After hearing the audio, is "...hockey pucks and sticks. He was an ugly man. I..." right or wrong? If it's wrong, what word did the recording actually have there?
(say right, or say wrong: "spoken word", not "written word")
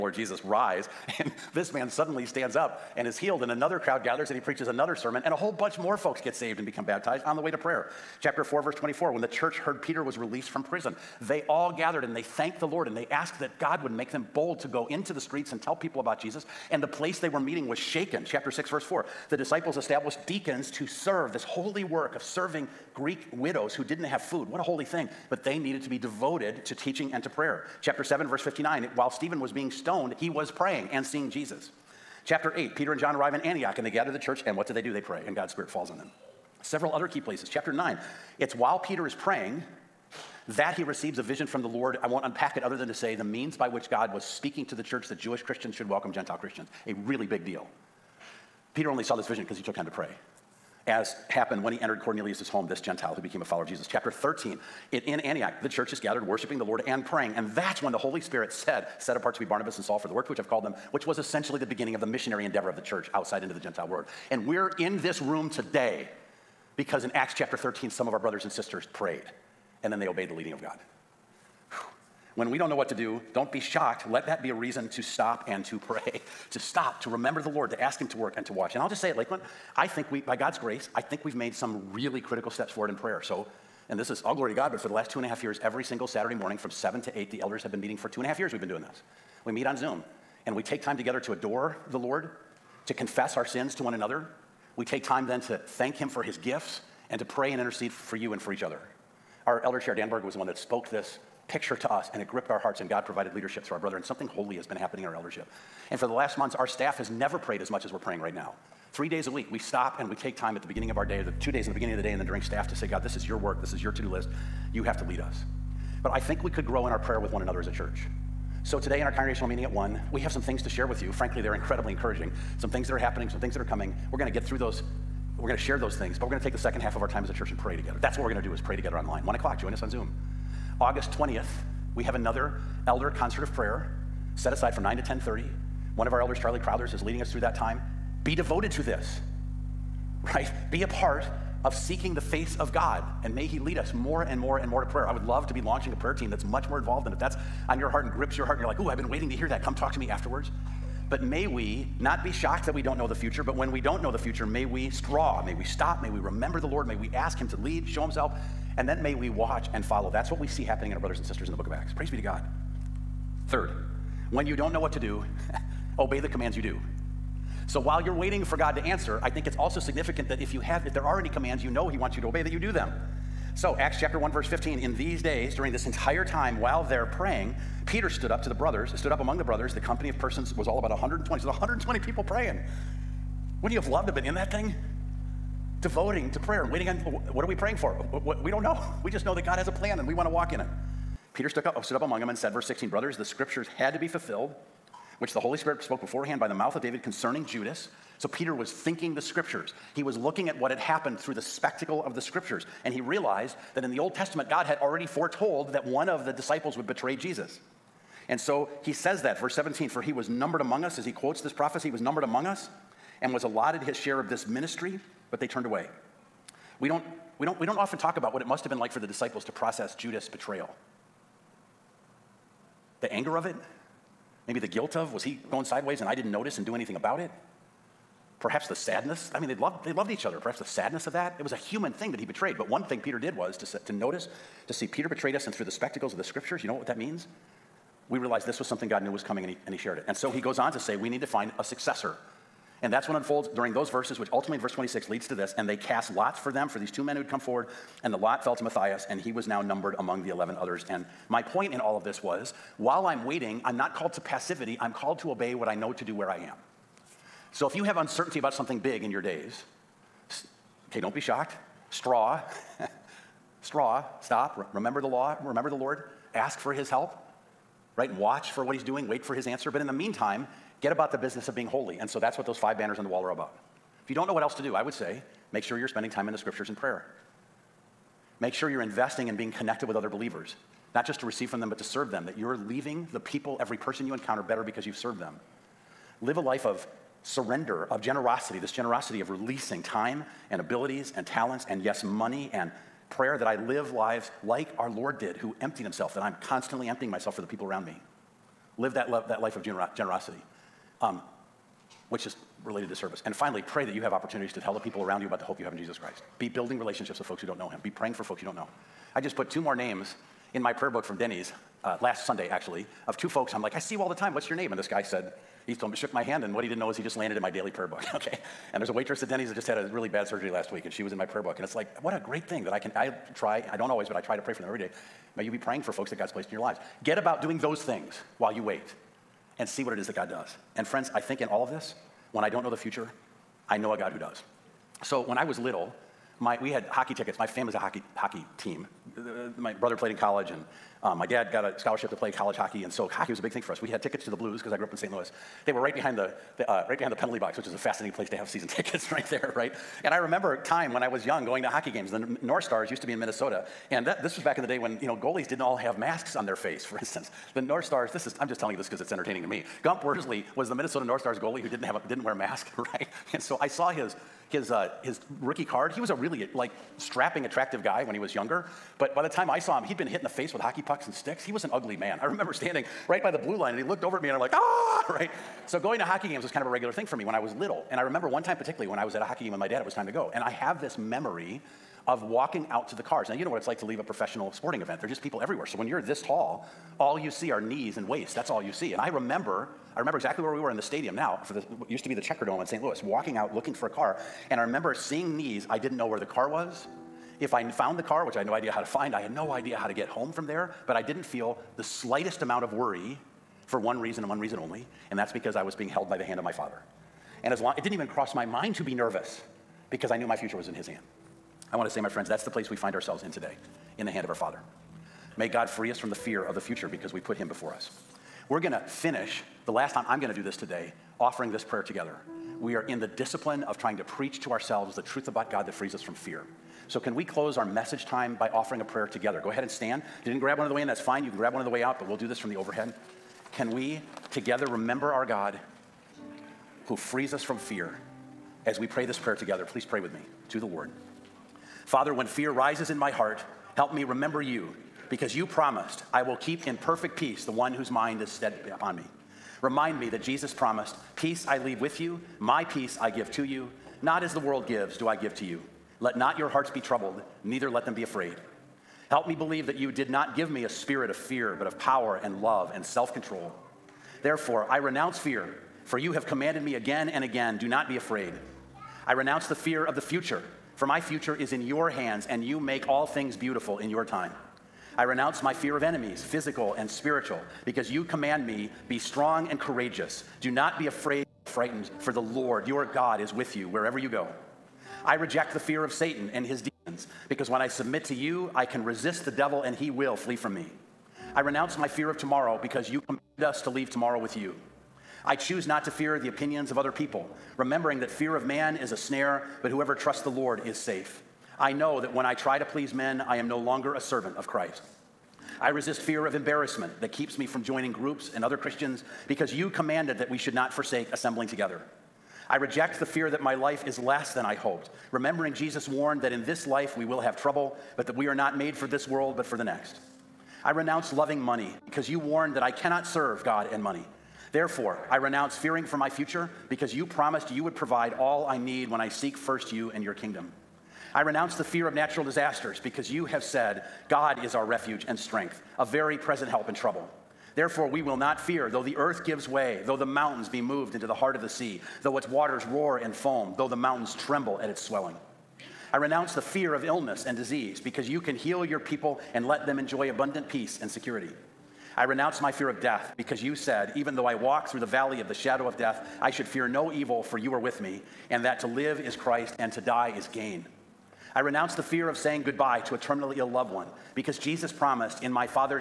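right.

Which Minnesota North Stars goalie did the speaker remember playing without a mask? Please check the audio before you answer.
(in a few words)
Gump Worsley.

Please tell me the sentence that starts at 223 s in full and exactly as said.
the anger of it, maybe the guilt of, was he going sideways and I didn't notice and do anything about it?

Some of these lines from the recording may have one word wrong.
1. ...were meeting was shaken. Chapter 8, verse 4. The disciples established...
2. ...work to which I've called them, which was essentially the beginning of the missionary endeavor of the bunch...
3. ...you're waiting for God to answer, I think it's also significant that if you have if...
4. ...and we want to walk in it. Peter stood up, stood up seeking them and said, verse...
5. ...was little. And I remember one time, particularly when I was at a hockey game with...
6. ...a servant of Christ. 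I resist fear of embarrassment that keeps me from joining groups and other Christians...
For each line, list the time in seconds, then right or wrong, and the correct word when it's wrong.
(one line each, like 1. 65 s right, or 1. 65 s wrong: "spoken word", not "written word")
1. 17 s wrong: "6", not "8"
2. 60 s wrong: "church", not "bunch"
3. 167 s right
4. 189 s wrong: "among", not "seeking"
5. 377 s right
6. 503 s right.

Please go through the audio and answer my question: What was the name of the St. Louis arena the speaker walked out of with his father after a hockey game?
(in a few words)
Checkerdome.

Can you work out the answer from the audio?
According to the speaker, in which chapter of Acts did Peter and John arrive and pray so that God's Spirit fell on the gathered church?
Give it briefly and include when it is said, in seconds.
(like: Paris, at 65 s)
Chapter 8, at 32 s.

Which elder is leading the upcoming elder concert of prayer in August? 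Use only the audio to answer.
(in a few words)
Charlie Crowthers.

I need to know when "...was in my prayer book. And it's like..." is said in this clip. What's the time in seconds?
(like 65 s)
321 s.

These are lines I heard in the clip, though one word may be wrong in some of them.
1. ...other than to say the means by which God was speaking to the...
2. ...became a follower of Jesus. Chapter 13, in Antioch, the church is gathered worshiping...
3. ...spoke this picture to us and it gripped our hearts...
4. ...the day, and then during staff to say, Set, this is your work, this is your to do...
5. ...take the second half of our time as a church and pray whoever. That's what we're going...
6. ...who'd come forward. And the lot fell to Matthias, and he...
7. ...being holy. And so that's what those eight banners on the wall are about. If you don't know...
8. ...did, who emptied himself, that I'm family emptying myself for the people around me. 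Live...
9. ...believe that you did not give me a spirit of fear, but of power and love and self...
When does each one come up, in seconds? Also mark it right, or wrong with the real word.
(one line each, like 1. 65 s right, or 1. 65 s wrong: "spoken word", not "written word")
1. 42 s right
2. 53 s right
3. 100 s right
4. 111 s wrong: "God", not "Set"
5. 126 s wrong: "together", not "whoever"
6. 247 s right
7. 271 s wrong: "five", not "eight"
8. 295 s wrong: "constantly", not "family"
9. 459 s right.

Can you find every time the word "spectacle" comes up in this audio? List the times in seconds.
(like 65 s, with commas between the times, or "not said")
201 s, 235 s.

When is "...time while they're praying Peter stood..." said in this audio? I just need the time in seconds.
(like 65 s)
176 s.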